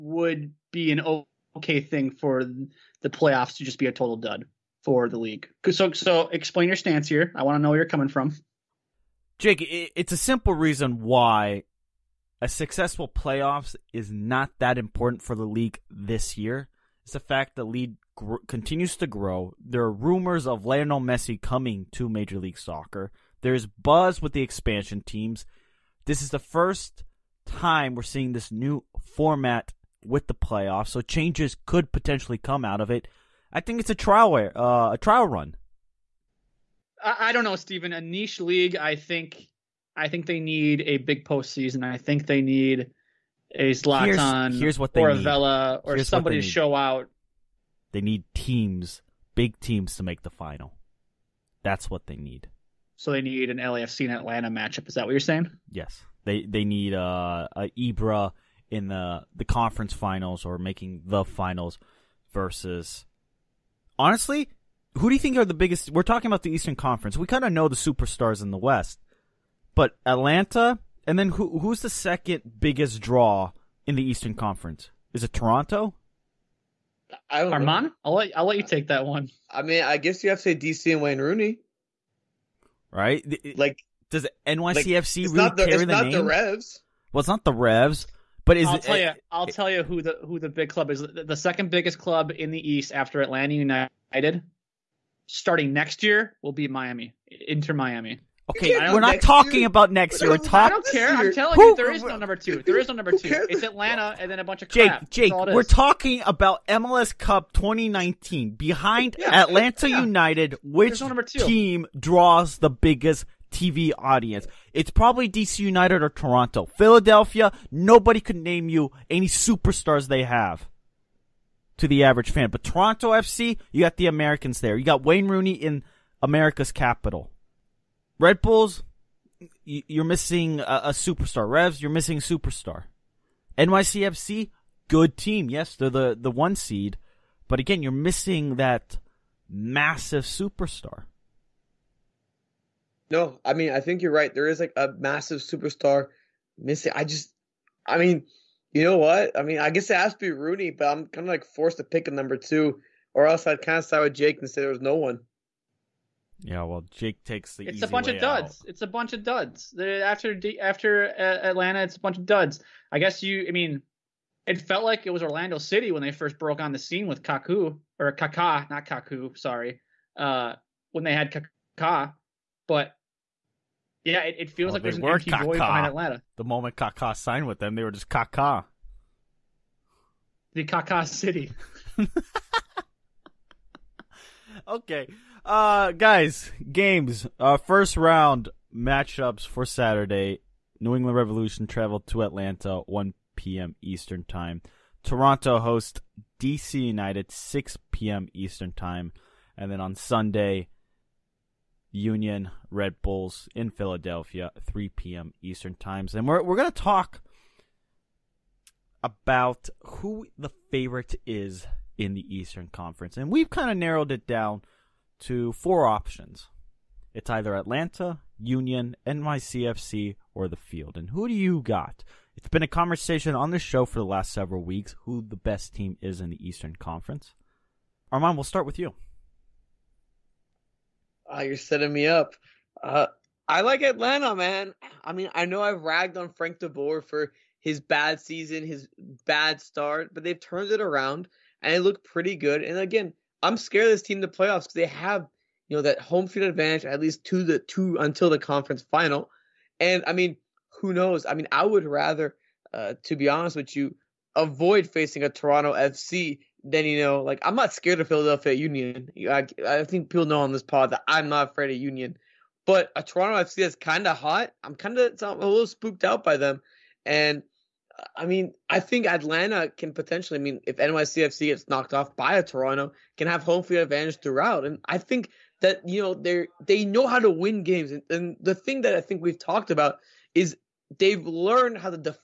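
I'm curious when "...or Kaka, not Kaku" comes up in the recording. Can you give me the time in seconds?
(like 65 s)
167 s.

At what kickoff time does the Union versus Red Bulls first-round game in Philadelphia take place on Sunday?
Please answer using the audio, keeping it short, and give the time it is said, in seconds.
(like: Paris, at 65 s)
3 p.m. Eastern, at 204 s.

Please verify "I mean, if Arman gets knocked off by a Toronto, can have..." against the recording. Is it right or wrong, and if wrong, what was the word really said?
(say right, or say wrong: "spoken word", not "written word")
wrong: "NYCFC", not "Arman".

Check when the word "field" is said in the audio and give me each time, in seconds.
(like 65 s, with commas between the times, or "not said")
220 s, 246 s, 273 s.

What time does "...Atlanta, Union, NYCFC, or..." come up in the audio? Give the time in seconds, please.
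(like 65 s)
217 s.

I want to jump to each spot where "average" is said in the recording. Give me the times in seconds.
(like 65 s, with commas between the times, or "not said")
122 s.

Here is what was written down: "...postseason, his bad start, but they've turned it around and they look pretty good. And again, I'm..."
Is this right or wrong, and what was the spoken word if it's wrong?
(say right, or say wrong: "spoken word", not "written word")
wrong: "season", not "postseason".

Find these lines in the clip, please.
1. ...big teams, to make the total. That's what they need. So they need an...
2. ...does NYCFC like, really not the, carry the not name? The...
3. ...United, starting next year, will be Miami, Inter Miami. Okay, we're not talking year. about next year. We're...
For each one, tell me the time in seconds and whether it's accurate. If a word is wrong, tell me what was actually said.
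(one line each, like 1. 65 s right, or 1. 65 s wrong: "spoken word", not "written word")
1. 49 s wrong: "final", not "total"
2. 84 s right
3. 93 s right.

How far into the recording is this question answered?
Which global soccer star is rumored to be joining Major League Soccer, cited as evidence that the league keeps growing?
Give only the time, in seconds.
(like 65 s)
20 s.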